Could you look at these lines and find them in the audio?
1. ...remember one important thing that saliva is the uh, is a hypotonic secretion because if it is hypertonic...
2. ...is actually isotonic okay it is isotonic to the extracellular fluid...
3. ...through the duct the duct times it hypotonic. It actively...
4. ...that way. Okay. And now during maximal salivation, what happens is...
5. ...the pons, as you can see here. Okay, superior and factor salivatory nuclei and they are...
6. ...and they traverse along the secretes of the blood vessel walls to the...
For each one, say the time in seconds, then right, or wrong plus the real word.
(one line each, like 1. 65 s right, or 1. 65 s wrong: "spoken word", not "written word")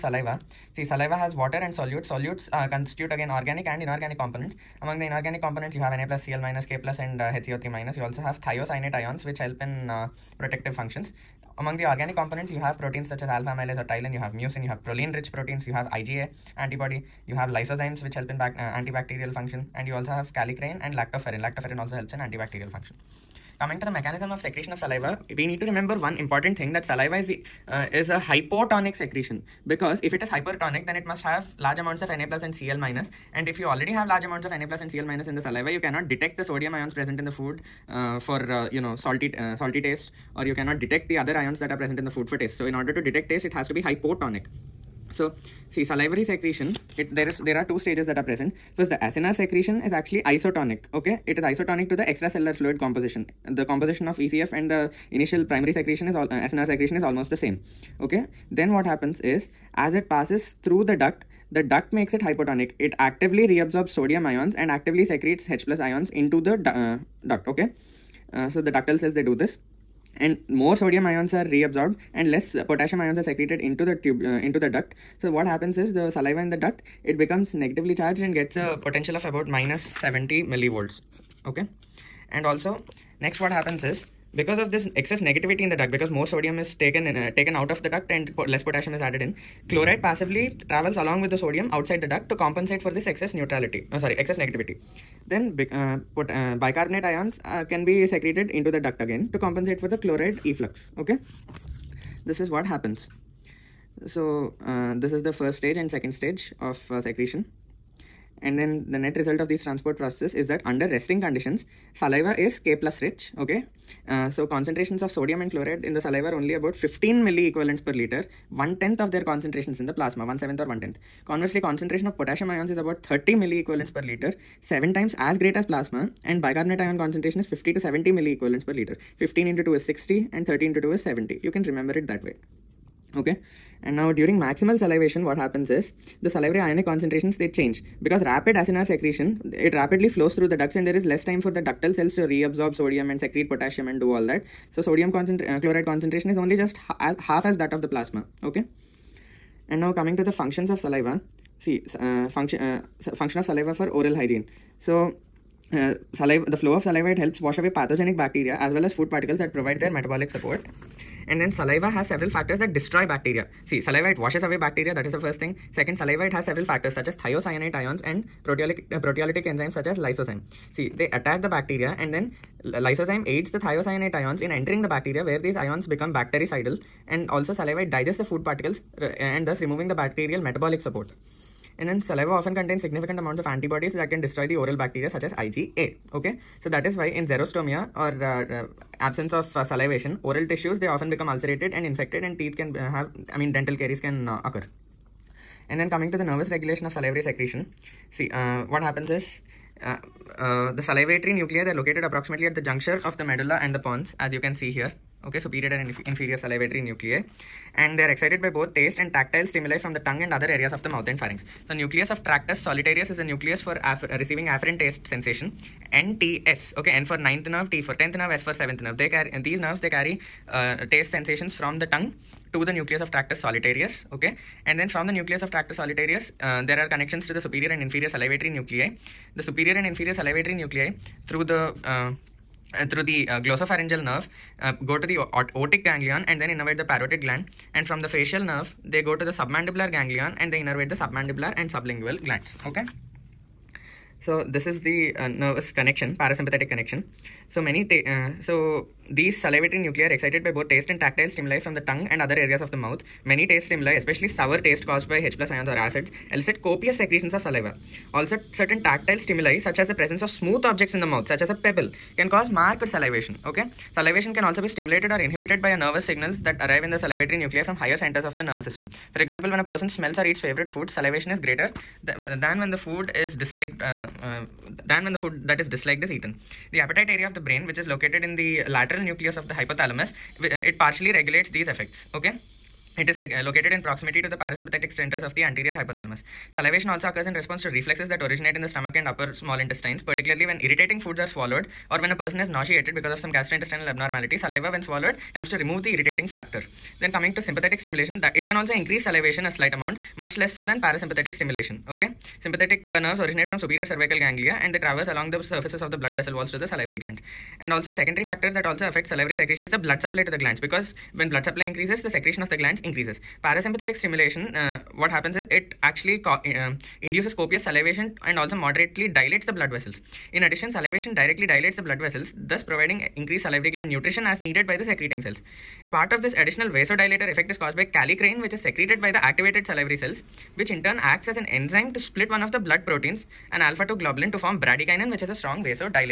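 1. 25 s right
2. 49 s right
3. 60 s wrong: "makes", not "times"
4. 132 s right
5. 203 s wrong: "inferior", not "factor"
6. 304 s wrong: "surfaces", not "secretes".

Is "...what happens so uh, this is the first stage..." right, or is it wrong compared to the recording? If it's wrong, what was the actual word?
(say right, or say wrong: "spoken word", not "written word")
right.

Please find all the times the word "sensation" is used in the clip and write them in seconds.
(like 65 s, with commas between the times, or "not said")
215 s, 221 s.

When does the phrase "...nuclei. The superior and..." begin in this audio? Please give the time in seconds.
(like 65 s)
228 s.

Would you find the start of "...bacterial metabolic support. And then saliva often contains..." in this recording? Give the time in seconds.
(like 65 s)
179 s.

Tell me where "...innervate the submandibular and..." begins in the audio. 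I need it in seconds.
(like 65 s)
240 s.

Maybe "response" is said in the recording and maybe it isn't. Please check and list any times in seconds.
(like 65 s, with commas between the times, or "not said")
287 s.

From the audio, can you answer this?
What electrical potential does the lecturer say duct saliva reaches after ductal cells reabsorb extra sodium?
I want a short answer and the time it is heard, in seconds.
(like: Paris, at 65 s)
-70 millivolts, at 79 s.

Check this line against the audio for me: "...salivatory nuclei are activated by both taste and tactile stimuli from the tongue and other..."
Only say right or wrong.
wrong.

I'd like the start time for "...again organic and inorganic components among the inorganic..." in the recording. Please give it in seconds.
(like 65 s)
3 s.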